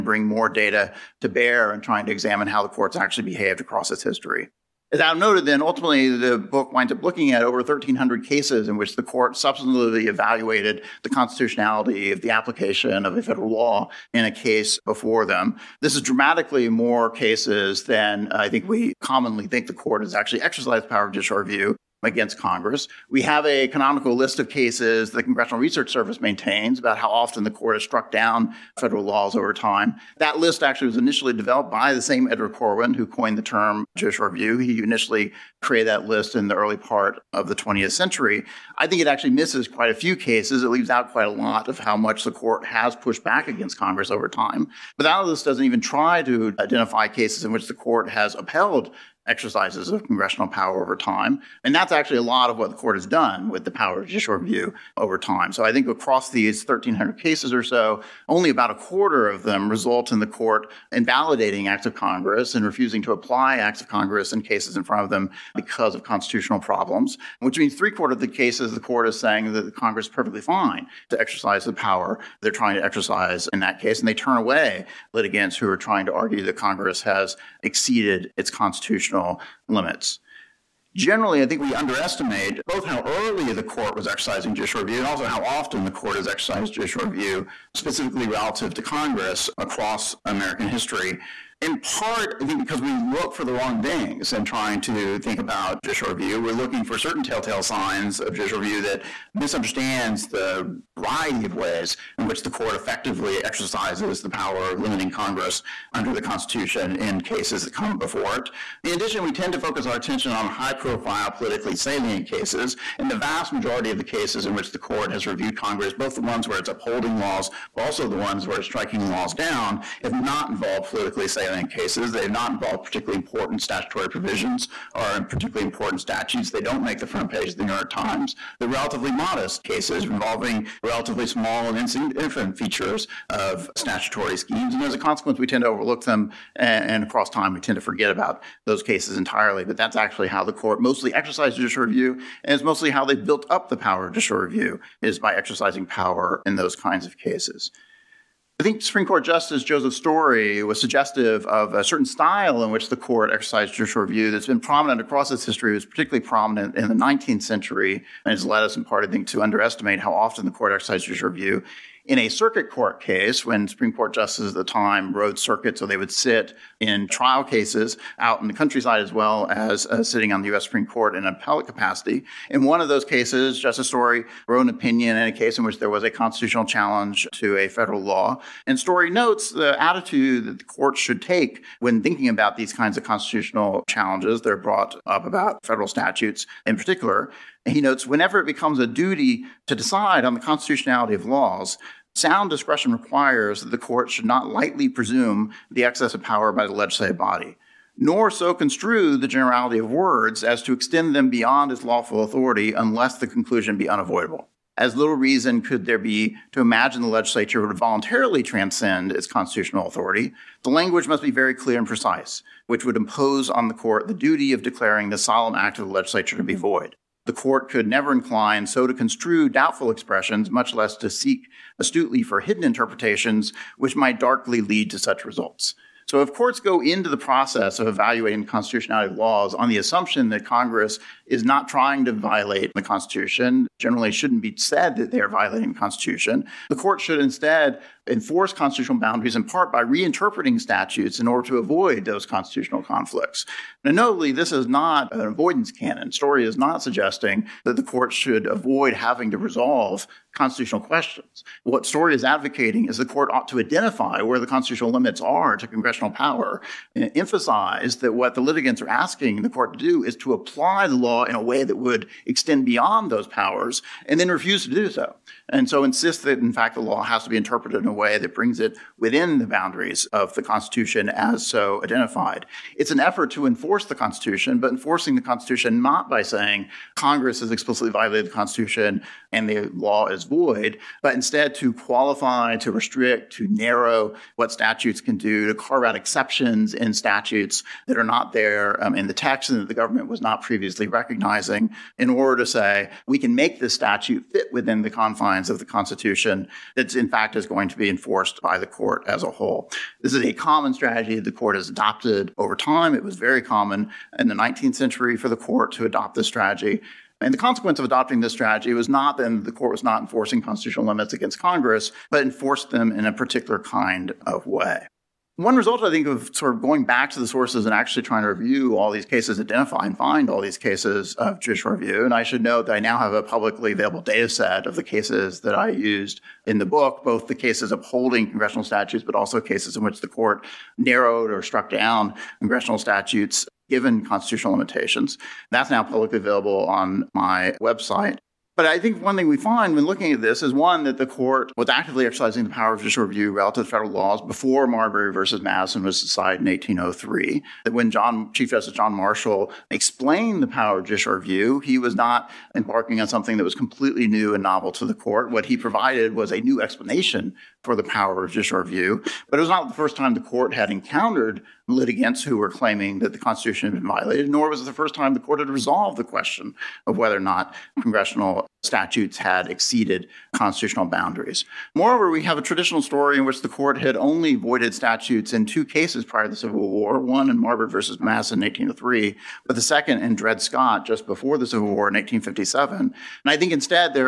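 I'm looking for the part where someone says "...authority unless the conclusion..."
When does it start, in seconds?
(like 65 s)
202 s.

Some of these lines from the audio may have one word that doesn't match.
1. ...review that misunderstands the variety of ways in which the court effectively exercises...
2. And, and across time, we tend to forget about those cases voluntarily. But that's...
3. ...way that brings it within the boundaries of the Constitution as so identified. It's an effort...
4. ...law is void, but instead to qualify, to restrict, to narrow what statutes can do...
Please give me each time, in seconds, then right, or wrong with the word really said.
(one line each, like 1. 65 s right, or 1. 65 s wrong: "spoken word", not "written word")
1. 98 s right
2. 136 s wrong: "entirely", not "voluntarily"
3. 267 s right
4. 279 s right.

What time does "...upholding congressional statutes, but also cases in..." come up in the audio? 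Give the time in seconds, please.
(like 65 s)
327 s.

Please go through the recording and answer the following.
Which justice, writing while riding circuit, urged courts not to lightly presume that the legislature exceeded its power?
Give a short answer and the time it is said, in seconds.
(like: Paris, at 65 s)
Joseph Story, at 149 s.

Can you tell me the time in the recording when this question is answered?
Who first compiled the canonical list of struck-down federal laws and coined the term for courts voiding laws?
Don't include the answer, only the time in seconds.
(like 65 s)
32 s.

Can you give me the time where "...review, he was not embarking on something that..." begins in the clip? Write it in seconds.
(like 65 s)
351 s.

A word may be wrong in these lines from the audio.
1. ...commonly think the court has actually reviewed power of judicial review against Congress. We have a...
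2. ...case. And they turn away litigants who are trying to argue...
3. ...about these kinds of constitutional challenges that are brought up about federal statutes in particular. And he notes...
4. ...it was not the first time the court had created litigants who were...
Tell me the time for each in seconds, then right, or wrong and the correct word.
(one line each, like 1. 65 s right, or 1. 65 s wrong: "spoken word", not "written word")
1. 19 s wrong: "exercised", not "reviewed"
2. 73 s right
3. 182 s right
4. 359 s wrong: "encountered", not "created".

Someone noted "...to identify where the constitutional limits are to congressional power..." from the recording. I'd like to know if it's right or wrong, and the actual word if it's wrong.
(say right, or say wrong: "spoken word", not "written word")
right.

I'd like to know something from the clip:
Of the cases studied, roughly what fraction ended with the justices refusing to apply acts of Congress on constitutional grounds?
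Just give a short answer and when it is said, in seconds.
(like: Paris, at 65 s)
a quarter, at 58 s.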